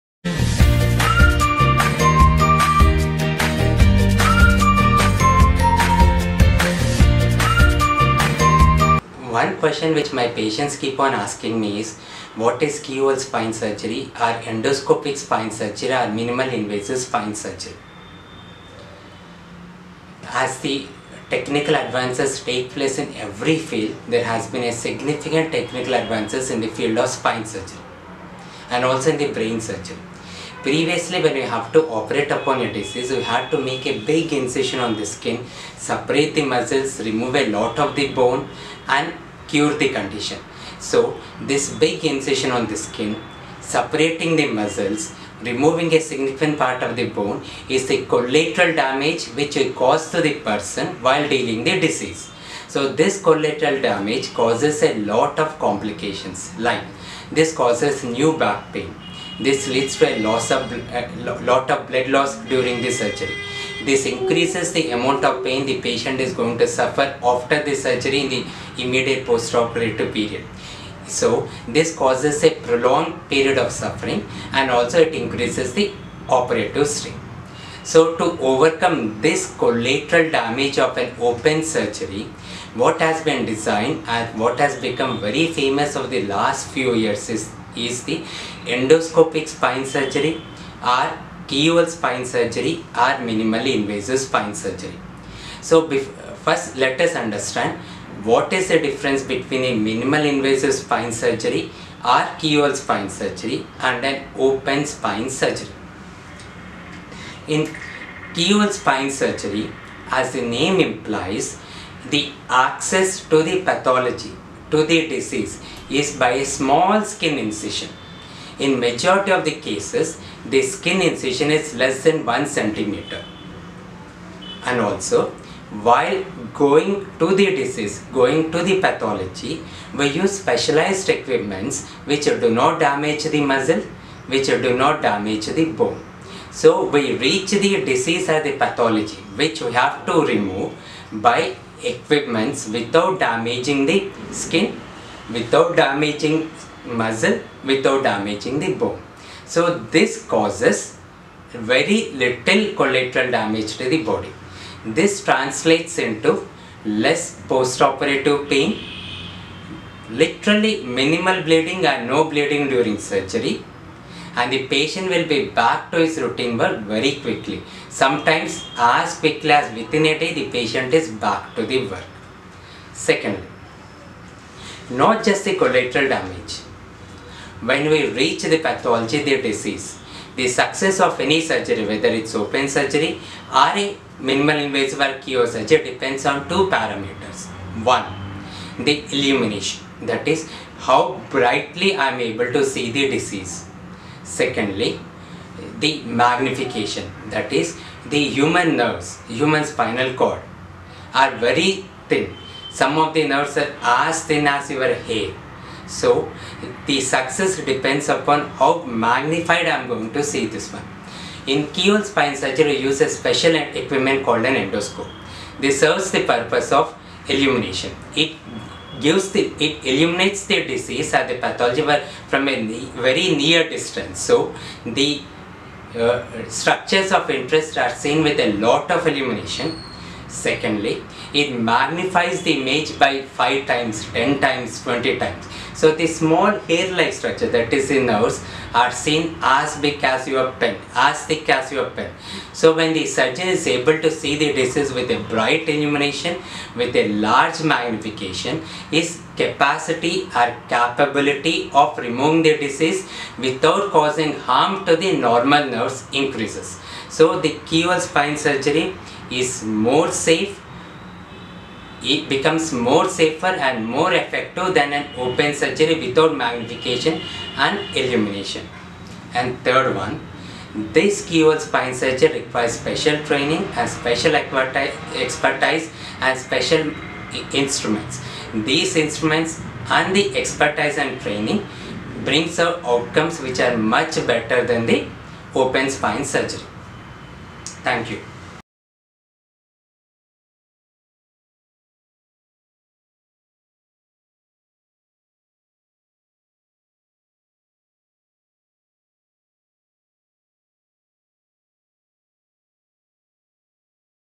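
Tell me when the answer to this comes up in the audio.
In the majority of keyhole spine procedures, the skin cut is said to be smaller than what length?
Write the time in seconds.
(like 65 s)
122 s.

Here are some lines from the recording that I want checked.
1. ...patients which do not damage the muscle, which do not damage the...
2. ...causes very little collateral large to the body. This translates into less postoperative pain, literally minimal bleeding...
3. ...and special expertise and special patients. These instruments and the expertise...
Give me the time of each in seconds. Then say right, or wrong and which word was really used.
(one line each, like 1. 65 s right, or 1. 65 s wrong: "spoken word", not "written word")
1. 131 s wrong: "equipments", not "patients"
2. 150 s wrong: "damage", not "large"
3. 273 s wrong: "instruments", not "patients".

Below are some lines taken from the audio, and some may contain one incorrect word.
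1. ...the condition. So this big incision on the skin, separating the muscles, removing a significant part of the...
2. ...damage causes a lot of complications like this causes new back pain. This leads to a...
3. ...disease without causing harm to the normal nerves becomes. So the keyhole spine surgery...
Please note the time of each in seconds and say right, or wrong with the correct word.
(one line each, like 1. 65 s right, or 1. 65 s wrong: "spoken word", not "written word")
1. 39 s right
2. 53 s right
3. 252 s wrong: "increases", not "becomes".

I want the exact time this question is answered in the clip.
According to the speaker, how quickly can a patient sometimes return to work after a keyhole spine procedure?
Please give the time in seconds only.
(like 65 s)
169 s.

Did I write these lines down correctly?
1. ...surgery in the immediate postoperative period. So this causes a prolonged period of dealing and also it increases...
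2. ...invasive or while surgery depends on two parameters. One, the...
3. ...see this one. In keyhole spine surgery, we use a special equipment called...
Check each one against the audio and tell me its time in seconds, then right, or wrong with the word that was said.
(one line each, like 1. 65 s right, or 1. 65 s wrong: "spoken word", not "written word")
1. 67 s wrong: "suffering", not "dealing"
2. 184 s wrong: "keyhole", not "while"
3. 210 s right.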